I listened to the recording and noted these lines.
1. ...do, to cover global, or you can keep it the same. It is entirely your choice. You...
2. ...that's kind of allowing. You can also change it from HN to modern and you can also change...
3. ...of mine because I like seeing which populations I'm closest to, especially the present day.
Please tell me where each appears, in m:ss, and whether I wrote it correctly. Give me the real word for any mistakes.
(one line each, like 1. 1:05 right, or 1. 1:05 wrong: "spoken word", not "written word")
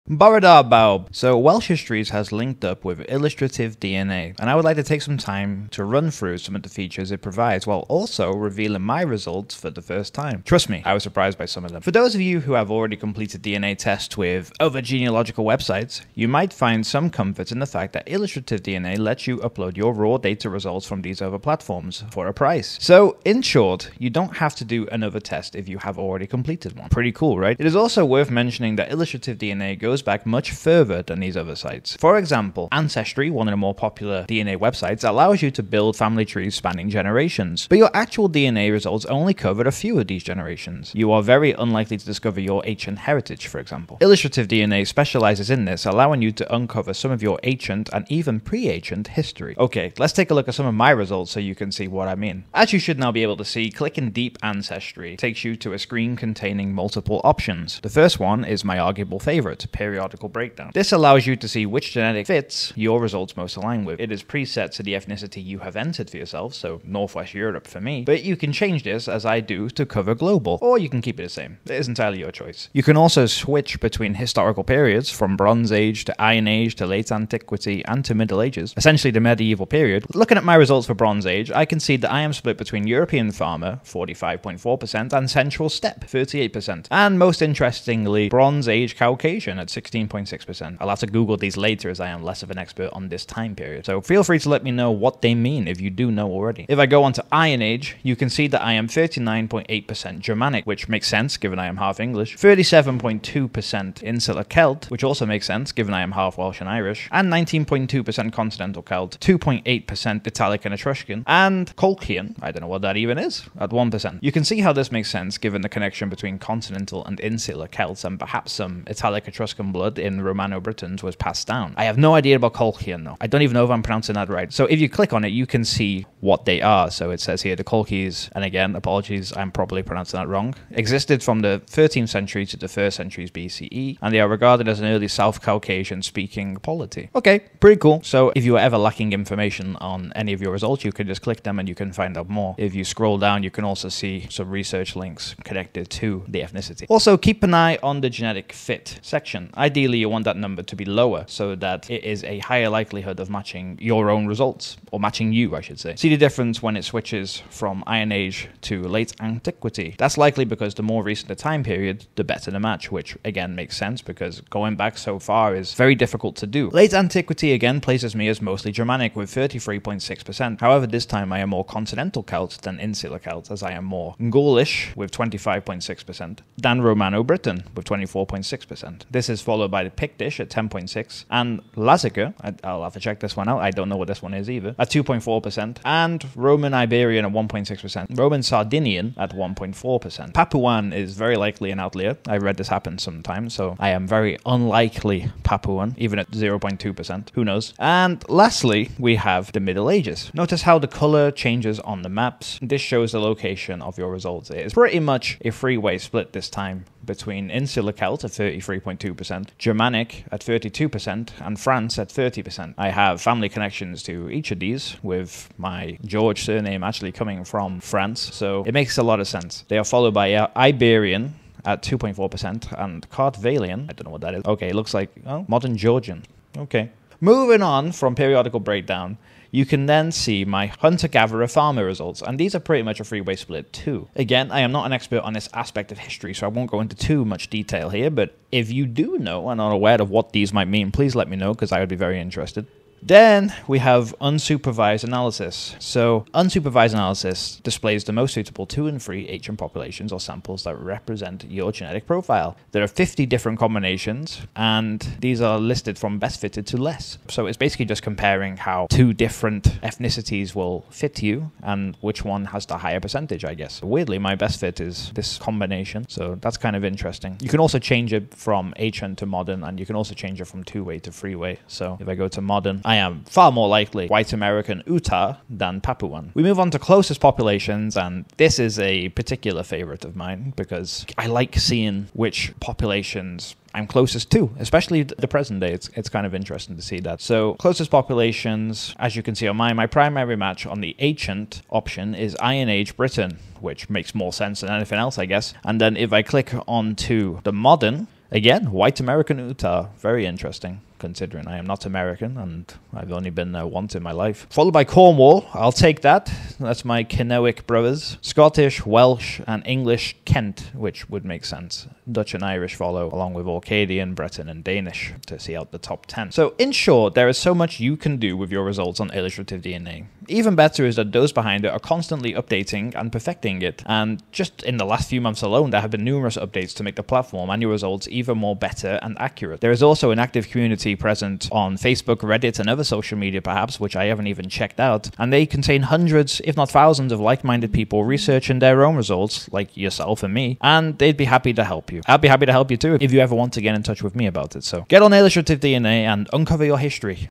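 1. 1:09 right
2. 4:26 wrong: "interesting", not "allowing"
3. 4:40 right.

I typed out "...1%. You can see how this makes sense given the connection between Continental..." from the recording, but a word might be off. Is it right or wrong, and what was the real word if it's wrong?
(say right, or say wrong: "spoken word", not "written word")
right.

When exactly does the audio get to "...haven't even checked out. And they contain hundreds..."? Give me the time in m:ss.
5:34.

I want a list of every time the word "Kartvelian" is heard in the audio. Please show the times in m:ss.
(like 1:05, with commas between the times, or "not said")
3:43.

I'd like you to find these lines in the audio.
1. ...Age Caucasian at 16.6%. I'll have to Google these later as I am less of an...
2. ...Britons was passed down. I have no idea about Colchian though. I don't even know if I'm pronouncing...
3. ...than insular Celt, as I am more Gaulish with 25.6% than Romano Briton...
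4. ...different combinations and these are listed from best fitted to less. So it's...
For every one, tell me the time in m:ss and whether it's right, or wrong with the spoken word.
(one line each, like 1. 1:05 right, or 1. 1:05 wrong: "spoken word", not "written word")
1. 1:28 right
2. 2:00 right
3. 2:52 right
4. 4:13 right.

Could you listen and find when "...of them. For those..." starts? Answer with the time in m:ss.
0:11.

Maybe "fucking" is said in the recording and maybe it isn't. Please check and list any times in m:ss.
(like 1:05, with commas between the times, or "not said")
not said.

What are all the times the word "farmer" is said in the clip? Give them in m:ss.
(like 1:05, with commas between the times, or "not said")
1:23, 3:51.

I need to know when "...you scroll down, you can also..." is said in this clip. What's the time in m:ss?
2:22.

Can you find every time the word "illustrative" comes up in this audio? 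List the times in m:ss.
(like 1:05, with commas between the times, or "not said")
0:03, 0:18, 0:28, 0:44, 5:19, 5:45.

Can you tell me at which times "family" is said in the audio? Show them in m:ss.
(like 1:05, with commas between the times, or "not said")
0:35, 3:33.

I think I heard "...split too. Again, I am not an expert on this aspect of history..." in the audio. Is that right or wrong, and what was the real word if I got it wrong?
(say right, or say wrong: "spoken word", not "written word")
right.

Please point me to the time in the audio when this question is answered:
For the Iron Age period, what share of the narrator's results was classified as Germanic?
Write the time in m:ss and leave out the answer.
1:38.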